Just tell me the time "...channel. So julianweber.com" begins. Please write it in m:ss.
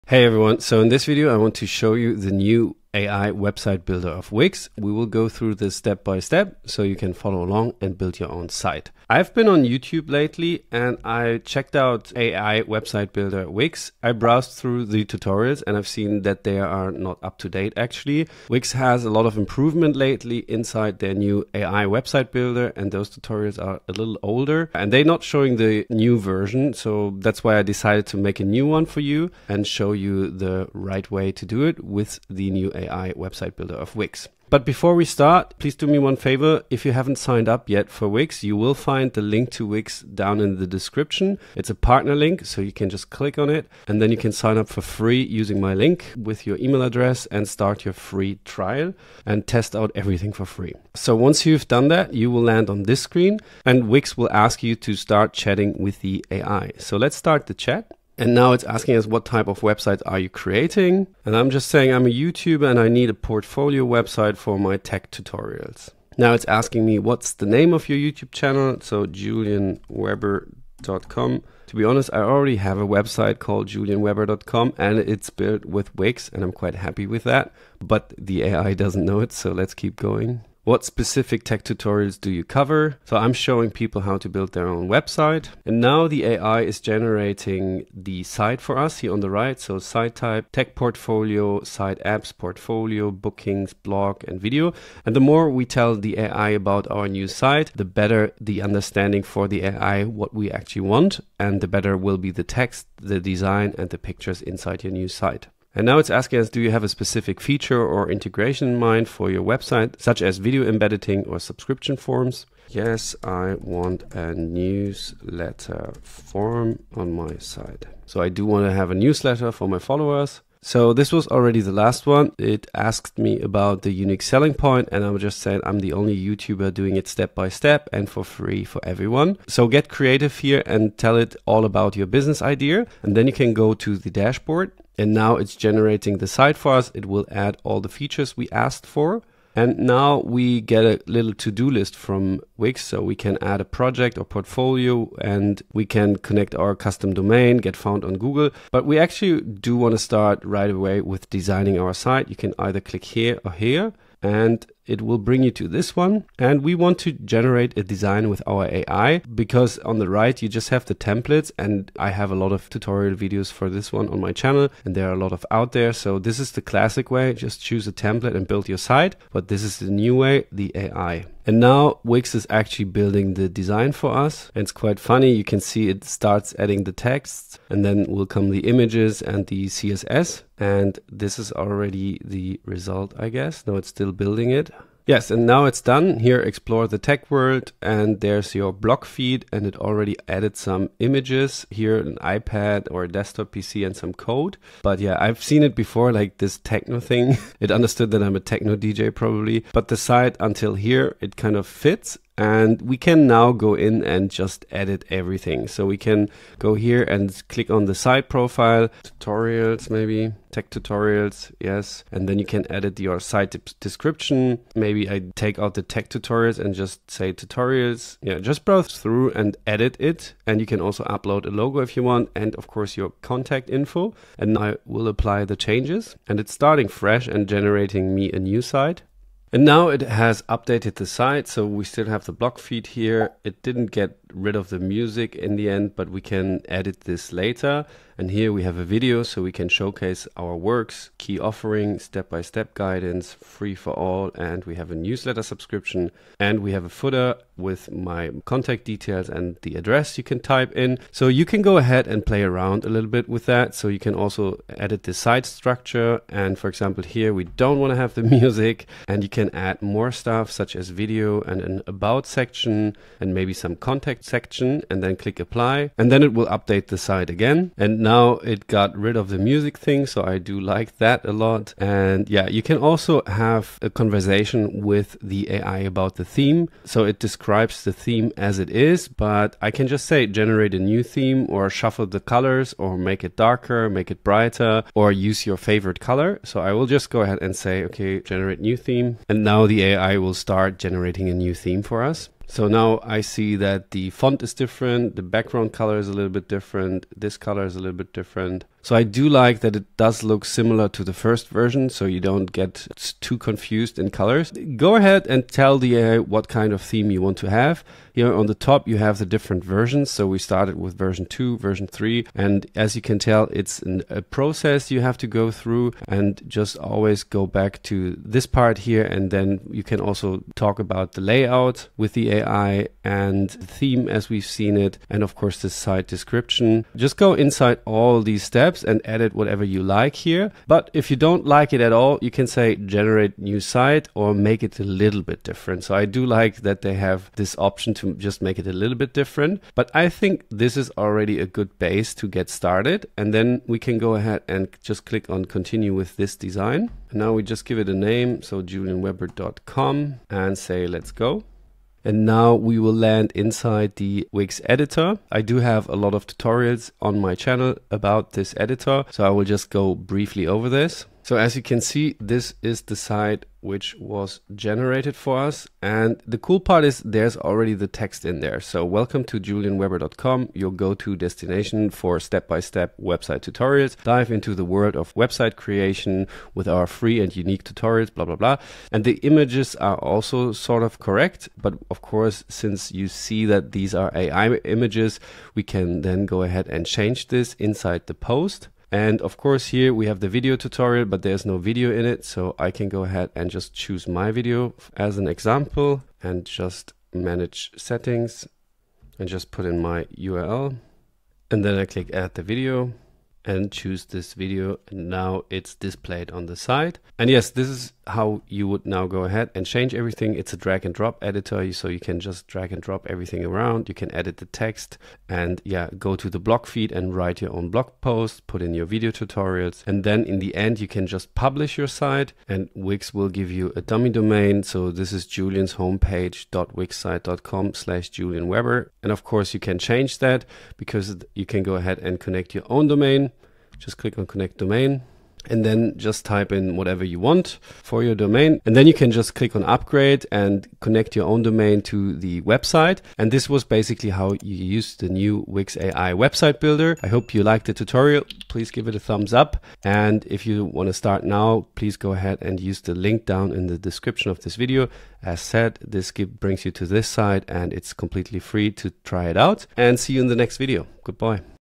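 1:08.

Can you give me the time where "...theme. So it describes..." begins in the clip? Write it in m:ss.
4:36.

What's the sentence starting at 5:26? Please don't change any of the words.
Just go inside all these steps steps and edit whatever you like here.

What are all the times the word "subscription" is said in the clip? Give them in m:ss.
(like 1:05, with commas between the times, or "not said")
1:51, 4:05.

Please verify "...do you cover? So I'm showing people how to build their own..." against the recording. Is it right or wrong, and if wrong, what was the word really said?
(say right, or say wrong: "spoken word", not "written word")
right.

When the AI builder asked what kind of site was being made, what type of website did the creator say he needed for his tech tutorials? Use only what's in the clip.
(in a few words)
portfolio website.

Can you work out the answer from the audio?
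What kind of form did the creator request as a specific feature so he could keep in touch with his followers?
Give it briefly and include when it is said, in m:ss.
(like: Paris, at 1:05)
newsletter form, at 1:54.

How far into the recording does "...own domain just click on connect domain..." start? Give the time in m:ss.
7:12.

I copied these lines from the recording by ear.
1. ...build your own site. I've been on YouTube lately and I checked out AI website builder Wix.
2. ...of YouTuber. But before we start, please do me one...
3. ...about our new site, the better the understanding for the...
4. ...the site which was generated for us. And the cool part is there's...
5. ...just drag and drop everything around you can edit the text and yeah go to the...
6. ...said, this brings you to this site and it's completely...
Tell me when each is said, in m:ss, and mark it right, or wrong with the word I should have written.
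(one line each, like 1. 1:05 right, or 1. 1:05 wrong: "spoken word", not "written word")
1. 0:07 right
2. 0:33 wrong: "Wix", not "YouTuber"
3. 1:36 right
4. 6:02 right
5. 6:52 right
6. 7:35 right.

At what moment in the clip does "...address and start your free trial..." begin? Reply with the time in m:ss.
0:46.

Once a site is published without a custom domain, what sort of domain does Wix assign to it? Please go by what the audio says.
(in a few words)
dummy domain.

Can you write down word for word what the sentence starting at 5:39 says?
But I think this is already a good base to get started.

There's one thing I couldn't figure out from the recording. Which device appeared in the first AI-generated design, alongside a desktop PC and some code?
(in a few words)
iPad.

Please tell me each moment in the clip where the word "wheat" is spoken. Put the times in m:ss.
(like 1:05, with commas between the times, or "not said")
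not said.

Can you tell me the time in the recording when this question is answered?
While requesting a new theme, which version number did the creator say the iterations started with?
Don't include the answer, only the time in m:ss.
5:10.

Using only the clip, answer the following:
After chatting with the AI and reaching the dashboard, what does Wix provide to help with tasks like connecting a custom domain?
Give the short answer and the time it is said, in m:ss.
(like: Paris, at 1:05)
to-do list, at 2:21.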